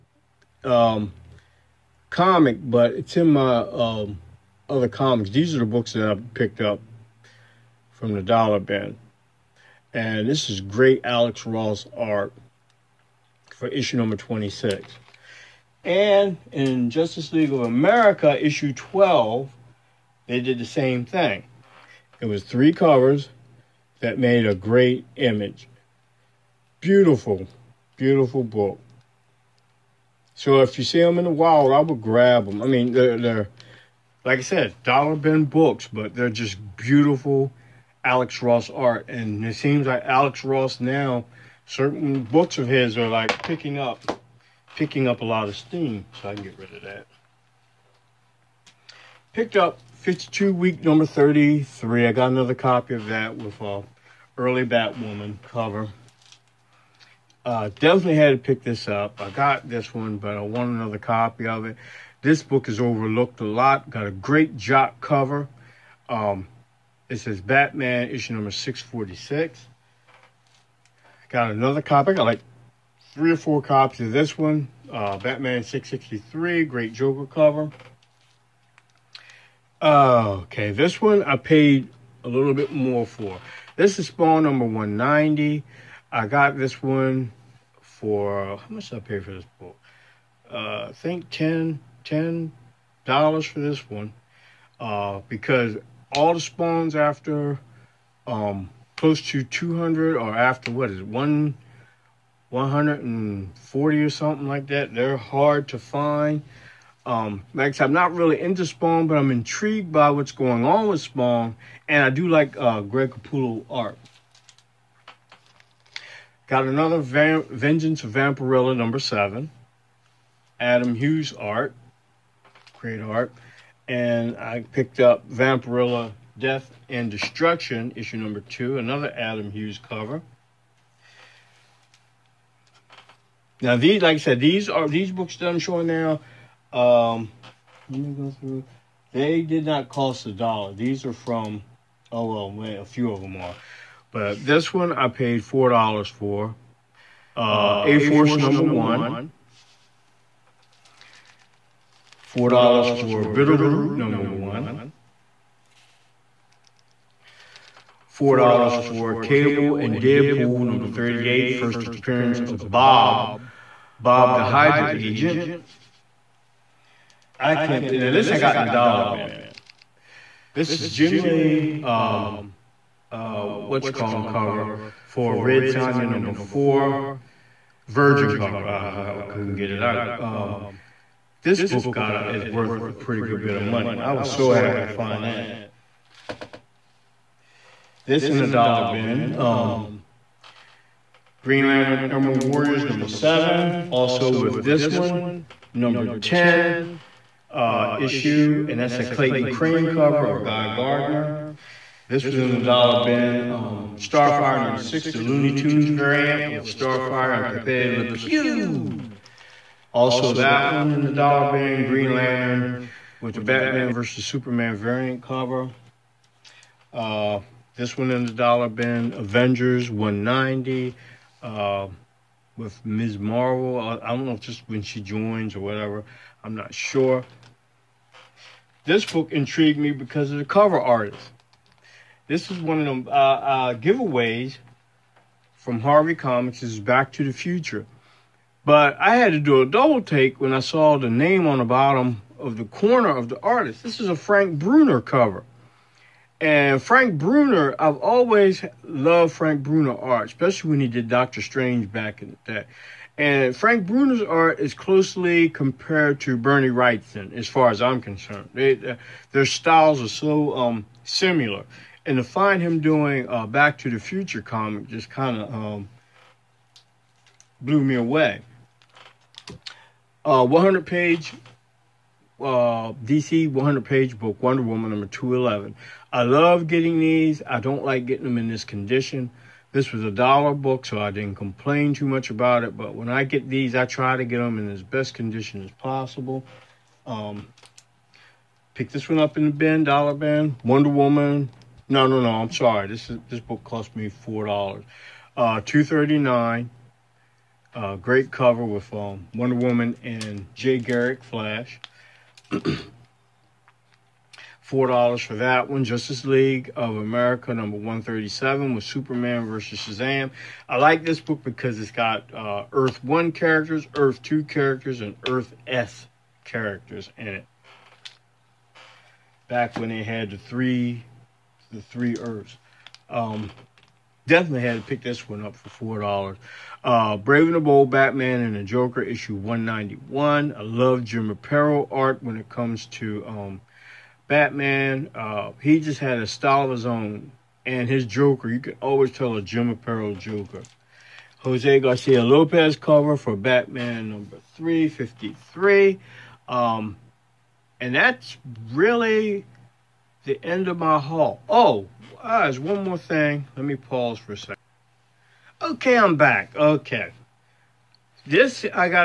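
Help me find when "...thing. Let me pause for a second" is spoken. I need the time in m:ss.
5:52.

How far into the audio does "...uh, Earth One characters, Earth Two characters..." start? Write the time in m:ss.
5:12.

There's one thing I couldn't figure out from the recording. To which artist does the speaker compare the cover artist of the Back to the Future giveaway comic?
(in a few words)
Bernie Wrightson.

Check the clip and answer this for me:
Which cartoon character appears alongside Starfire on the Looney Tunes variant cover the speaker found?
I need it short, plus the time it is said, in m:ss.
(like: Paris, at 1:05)
Pepe Le Pew, at 3:27.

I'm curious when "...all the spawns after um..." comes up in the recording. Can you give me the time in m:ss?
1:36.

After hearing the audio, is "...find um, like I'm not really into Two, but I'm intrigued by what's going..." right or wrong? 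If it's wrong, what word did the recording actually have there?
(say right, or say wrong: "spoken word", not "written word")
wrong: "Spawn", not "Two".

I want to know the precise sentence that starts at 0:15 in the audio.
And in Justice League of America, issue 12, they did the same thing.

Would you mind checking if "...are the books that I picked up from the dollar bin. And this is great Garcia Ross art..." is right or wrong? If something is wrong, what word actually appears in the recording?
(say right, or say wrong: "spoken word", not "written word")
wrong: "Alex", not "Garcia".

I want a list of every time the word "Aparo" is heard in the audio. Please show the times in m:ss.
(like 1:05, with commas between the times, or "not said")
5:31, 5:39.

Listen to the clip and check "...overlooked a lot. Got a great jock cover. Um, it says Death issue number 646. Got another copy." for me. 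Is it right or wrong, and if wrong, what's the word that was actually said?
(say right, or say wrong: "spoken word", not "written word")
wrong: "Batman", not "Death".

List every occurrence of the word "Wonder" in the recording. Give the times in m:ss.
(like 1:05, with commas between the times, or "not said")
4:34, 4:50, 4:59.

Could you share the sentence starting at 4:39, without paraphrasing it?
This was a dollar book, so I didn't complain too much about it.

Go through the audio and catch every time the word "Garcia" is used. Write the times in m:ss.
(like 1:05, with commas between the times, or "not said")
5:41.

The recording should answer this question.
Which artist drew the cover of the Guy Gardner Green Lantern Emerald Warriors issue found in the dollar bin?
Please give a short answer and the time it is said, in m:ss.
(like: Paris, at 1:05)
Clayton Crain, at 3:19.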